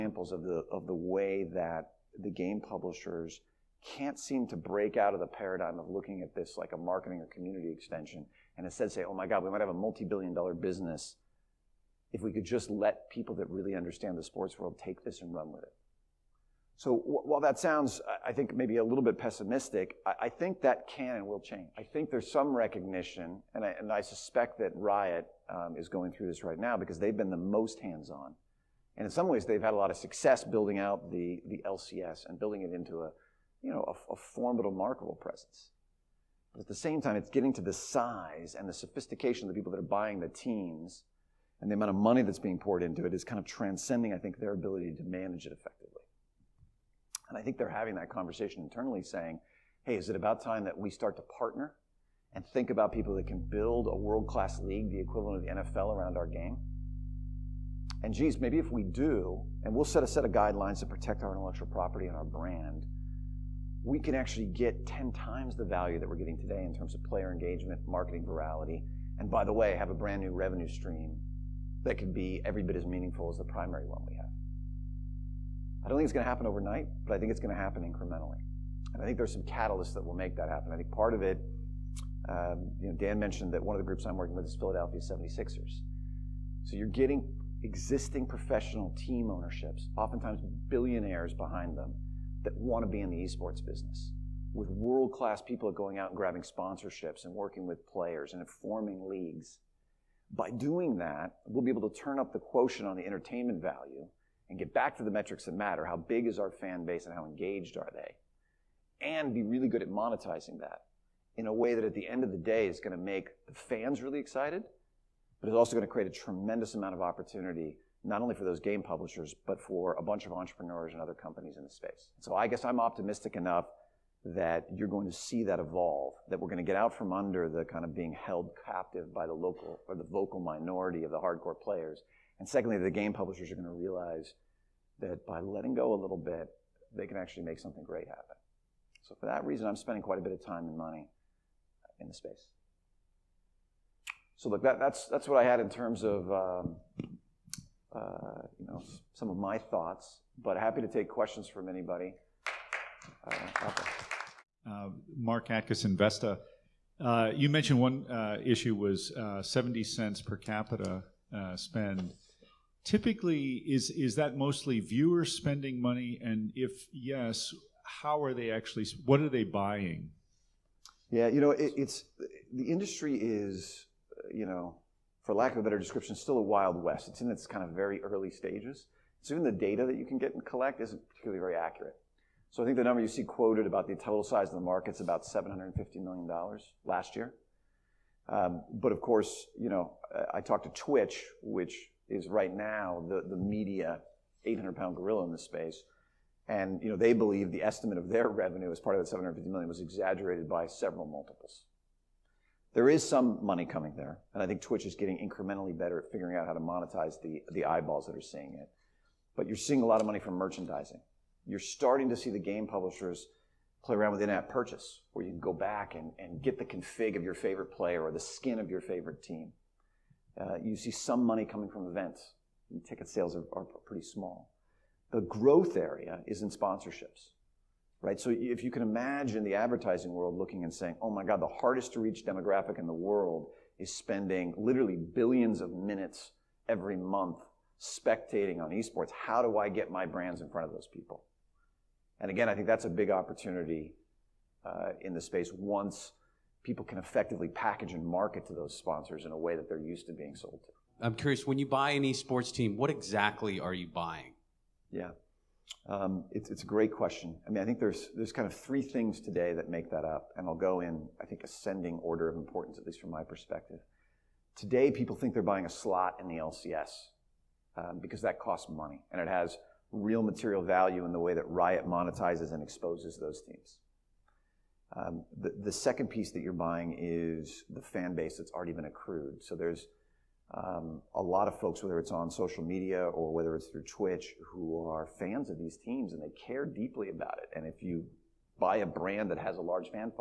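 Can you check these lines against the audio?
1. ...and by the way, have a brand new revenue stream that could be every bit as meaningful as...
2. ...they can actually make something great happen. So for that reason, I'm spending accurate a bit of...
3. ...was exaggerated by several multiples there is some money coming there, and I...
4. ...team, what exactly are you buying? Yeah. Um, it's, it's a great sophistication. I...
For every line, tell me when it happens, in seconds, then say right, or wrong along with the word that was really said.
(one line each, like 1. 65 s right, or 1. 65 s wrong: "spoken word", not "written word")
1. 69 s right
2. 136 s wrong: "quite", not "accurate"
3. 199 s right
4. 252 s wrong: "question", not "sophistication".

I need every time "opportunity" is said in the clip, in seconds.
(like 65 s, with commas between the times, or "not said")
117 s, 243 s.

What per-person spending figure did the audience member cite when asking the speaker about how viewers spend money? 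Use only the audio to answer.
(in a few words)
70 cents.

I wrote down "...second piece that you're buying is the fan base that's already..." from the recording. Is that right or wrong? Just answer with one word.
right.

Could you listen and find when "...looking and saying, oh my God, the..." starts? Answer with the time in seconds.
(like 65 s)
230 s.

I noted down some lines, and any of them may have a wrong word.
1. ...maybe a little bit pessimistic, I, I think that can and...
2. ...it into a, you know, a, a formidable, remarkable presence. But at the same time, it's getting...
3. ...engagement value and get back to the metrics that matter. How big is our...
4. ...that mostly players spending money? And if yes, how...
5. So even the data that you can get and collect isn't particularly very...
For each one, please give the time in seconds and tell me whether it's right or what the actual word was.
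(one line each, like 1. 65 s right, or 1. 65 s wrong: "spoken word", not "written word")
1. 18 s right
2. 32 s right
3. 103 s wrong: "entertainment", not "engagement"
4. 164 s wrong: "viewers", not "players"
5. 179 s right.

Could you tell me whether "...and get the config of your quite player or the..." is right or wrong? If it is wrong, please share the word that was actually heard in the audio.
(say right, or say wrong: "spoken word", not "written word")
wrong: "favorite", not "quite".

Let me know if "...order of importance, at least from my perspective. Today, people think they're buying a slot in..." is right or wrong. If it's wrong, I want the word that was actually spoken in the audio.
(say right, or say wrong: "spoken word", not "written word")
right.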